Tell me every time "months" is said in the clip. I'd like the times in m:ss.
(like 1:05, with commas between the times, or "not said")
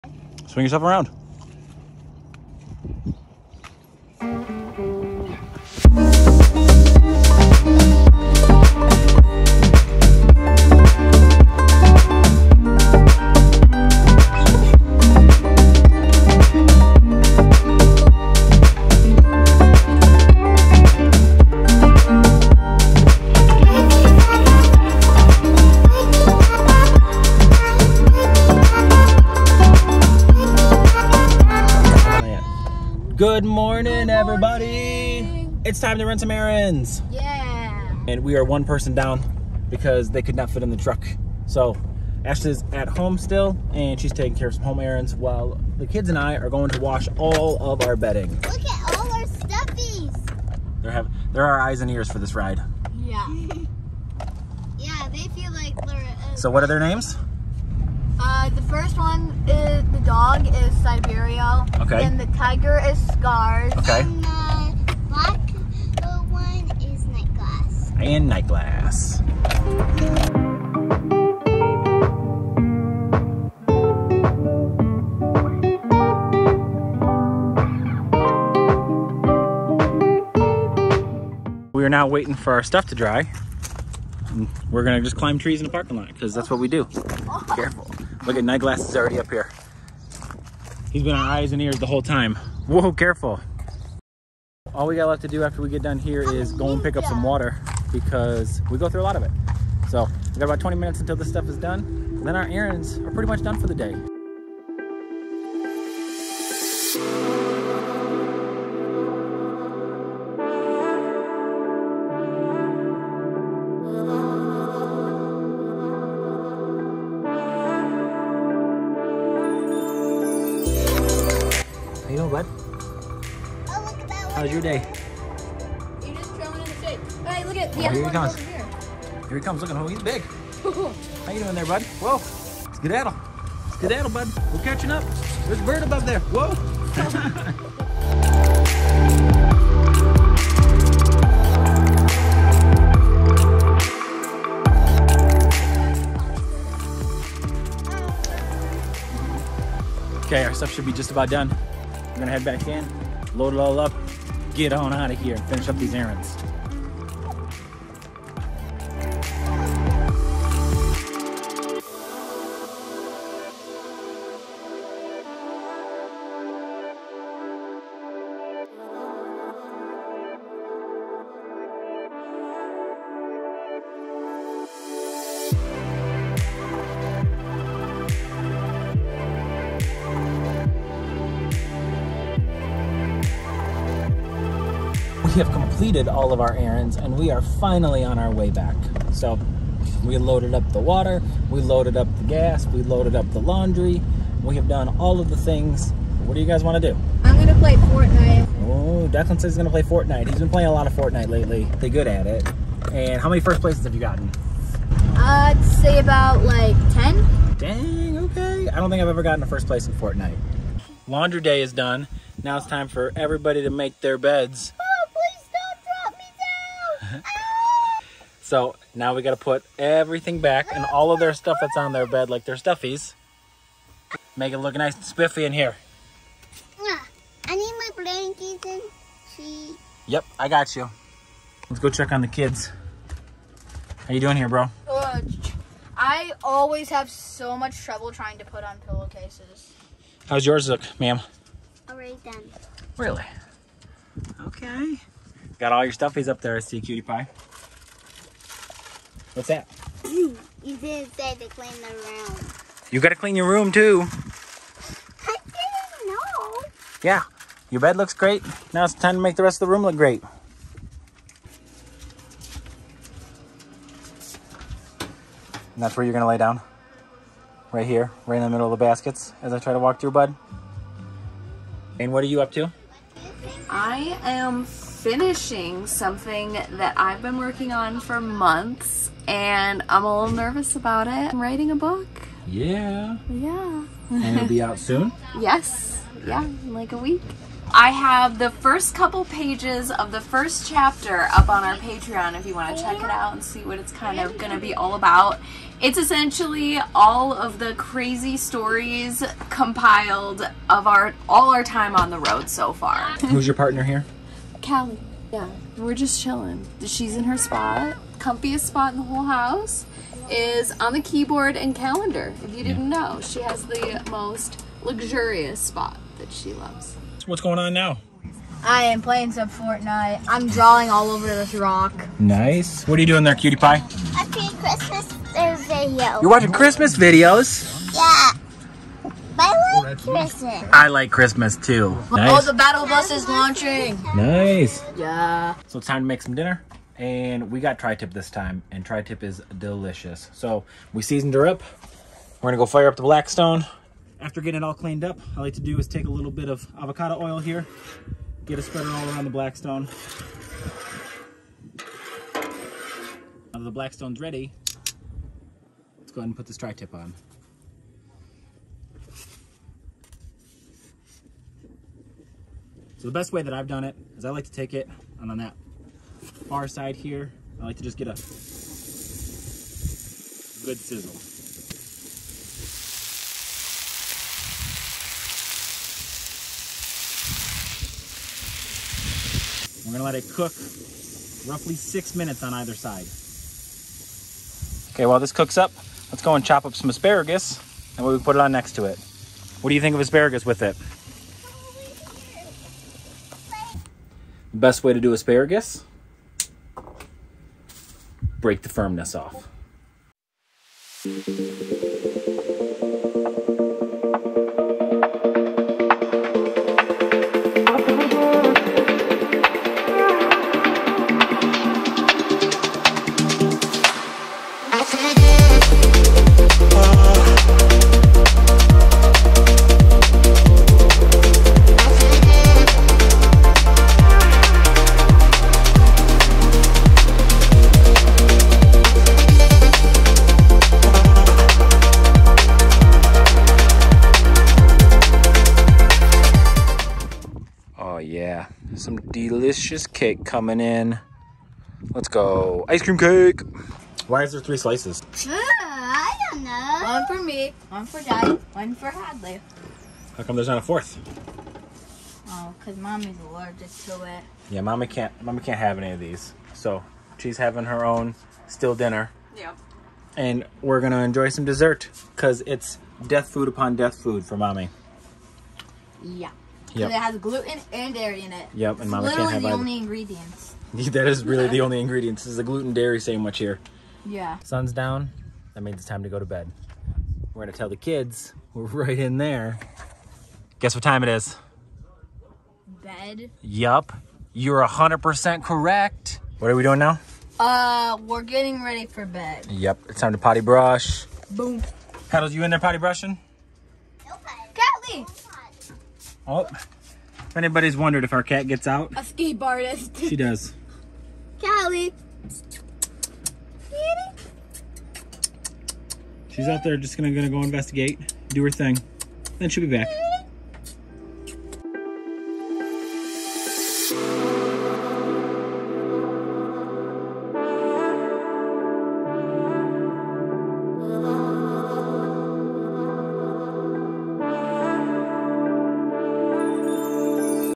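4:38.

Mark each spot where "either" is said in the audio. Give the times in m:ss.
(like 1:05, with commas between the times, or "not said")
6:22, 7:49.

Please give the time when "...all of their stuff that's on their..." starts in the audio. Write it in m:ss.
3:40.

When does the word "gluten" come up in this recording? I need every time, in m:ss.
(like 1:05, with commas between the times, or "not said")
7:47, 7:52.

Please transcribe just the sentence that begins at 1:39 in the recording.
So we got about 20 minutes until this stuff is done.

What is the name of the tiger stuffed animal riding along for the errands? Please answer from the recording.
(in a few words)
Scars.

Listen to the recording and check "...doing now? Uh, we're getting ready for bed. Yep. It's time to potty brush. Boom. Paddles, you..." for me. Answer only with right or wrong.
right.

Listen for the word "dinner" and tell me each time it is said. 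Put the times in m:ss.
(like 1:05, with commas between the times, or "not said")
5:36, 7:38.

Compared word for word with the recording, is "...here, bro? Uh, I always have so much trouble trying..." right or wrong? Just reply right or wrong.
right.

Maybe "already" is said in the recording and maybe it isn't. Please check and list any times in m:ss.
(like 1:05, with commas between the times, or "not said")
1:28, 4:01.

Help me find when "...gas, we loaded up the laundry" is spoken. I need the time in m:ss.
3:12.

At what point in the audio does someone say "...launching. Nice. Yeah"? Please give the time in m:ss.
5:33.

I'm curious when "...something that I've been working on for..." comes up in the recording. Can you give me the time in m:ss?
4:35.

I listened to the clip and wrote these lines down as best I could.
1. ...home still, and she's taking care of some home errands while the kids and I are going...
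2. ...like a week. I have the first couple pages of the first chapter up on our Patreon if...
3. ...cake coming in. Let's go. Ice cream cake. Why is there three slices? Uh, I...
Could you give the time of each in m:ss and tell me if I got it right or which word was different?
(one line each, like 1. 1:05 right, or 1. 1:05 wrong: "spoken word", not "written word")
1. 0:42 right
2. 4:46 right
3. 7:19 right.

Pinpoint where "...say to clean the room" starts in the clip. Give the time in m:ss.
4:11.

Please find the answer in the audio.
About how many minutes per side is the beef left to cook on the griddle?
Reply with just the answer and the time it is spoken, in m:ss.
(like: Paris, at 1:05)
6, at 6:21.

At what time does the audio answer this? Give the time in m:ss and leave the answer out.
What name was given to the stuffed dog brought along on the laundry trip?
0:59.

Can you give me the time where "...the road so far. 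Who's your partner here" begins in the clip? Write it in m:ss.
5:02.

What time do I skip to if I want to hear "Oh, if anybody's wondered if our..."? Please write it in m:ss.
8:16.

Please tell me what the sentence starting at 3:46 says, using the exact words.
Yeah, I need my blankets and sheets.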